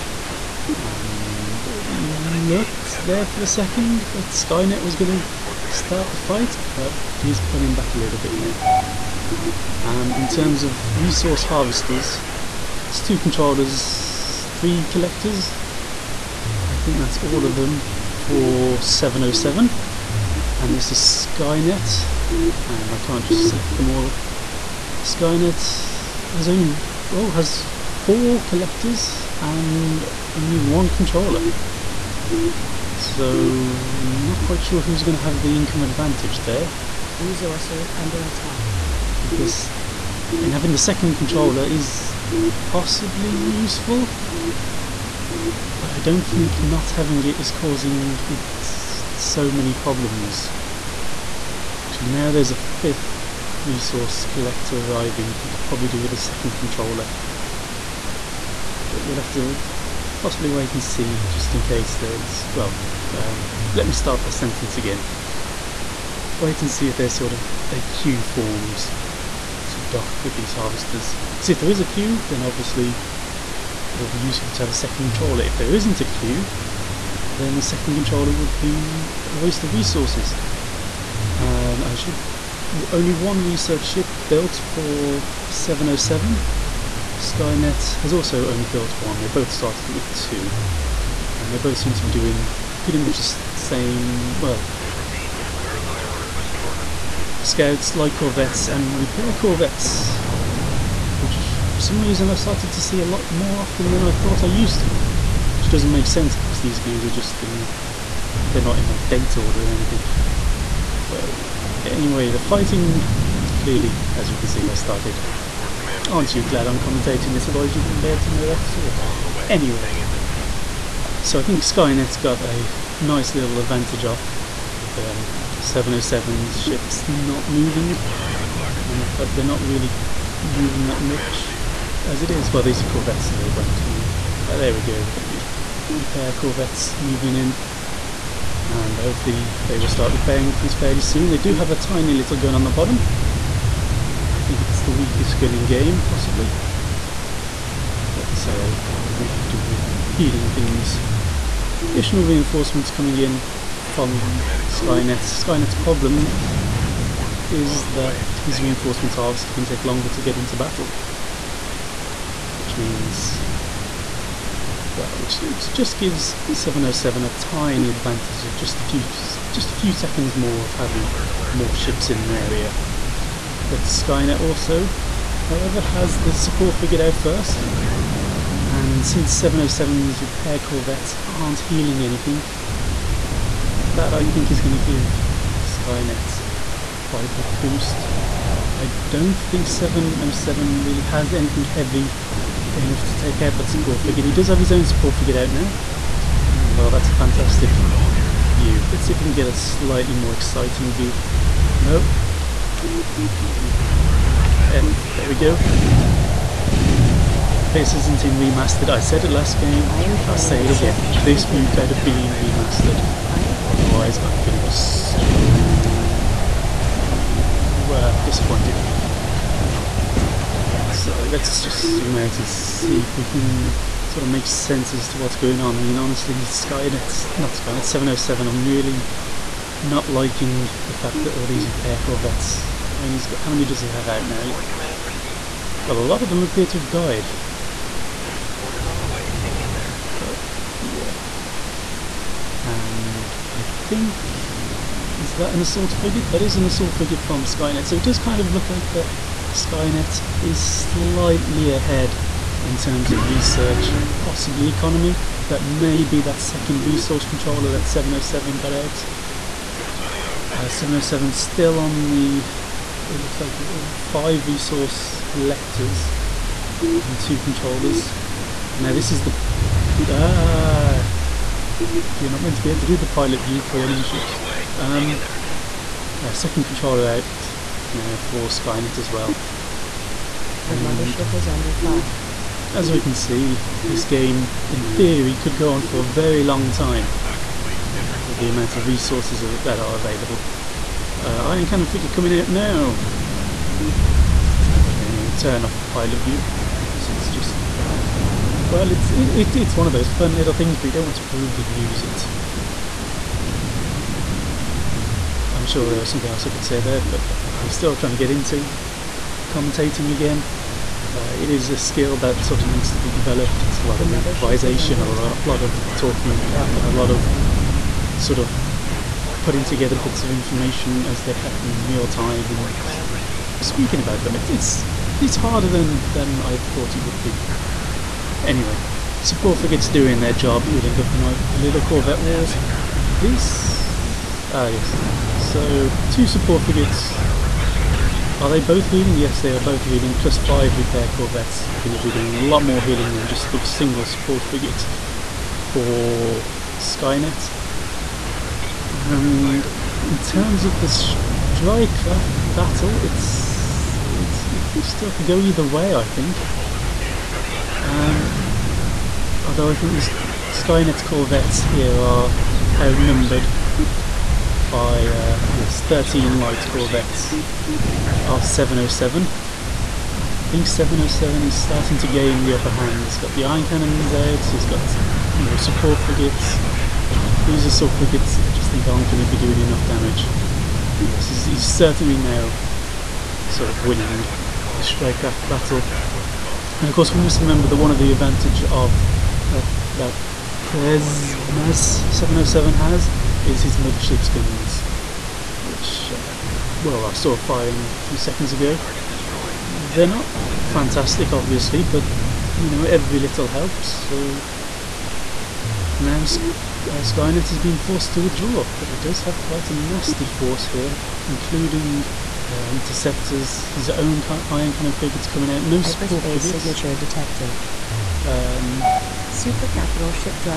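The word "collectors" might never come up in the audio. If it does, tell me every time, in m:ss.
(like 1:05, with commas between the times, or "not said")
0:14, 0:28, 0:54, 4:25.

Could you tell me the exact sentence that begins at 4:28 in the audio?
And now this is the, ah, you're not meant to be able to do the pilot view for enemy ships.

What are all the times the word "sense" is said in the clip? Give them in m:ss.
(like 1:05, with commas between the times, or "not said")
1:46, 3:44.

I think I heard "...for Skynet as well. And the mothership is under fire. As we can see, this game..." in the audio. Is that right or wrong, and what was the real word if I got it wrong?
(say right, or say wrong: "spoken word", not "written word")
right.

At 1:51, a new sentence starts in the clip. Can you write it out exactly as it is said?
But anyway, the fighting clearly, as you can see, has started.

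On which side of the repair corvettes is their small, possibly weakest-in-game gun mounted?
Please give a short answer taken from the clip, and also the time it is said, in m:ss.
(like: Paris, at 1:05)
The bottom, at 2:22.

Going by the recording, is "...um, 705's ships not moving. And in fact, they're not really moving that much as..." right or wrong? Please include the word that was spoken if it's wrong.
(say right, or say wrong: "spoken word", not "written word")
wrong: "707", not "705".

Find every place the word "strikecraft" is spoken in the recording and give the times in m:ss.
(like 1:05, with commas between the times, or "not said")
5:50, 6:24.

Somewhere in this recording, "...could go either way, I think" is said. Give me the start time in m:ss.
5:55.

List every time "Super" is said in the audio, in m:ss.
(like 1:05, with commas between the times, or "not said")
6:59.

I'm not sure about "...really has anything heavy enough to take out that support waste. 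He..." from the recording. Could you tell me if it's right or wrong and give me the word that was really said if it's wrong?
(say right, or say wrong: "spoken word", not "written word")
wrong: "frigate", not "waste".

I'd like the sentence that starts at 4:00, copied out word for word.
But yeah and I think is that an assault frigate?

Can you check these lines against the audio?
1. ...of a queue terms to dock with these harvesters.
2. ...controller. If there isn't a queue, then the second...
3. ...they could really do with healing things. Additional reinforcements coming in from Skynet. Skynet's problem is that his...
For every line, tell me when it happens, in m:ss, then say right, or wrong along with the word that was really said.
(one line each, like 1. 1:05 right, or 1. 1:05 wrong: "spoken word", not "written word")
1. 1:07 wrong: "forms", not "terms"
2. 1:15 right
3. 2:28 right.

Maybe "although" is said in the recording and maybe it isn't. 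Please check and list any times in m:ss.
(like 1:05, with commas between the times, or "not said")
5:59.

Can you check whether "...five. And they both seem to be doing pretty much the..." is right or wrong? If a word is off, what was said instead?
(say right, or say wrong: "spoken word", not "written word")
wrong: "two", not "five".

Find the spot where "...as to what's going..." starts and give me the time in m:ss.
3:44.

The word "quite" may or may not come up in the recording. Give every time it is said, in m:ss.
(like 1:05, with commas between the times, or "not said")
0:34, 3:07, 6:49.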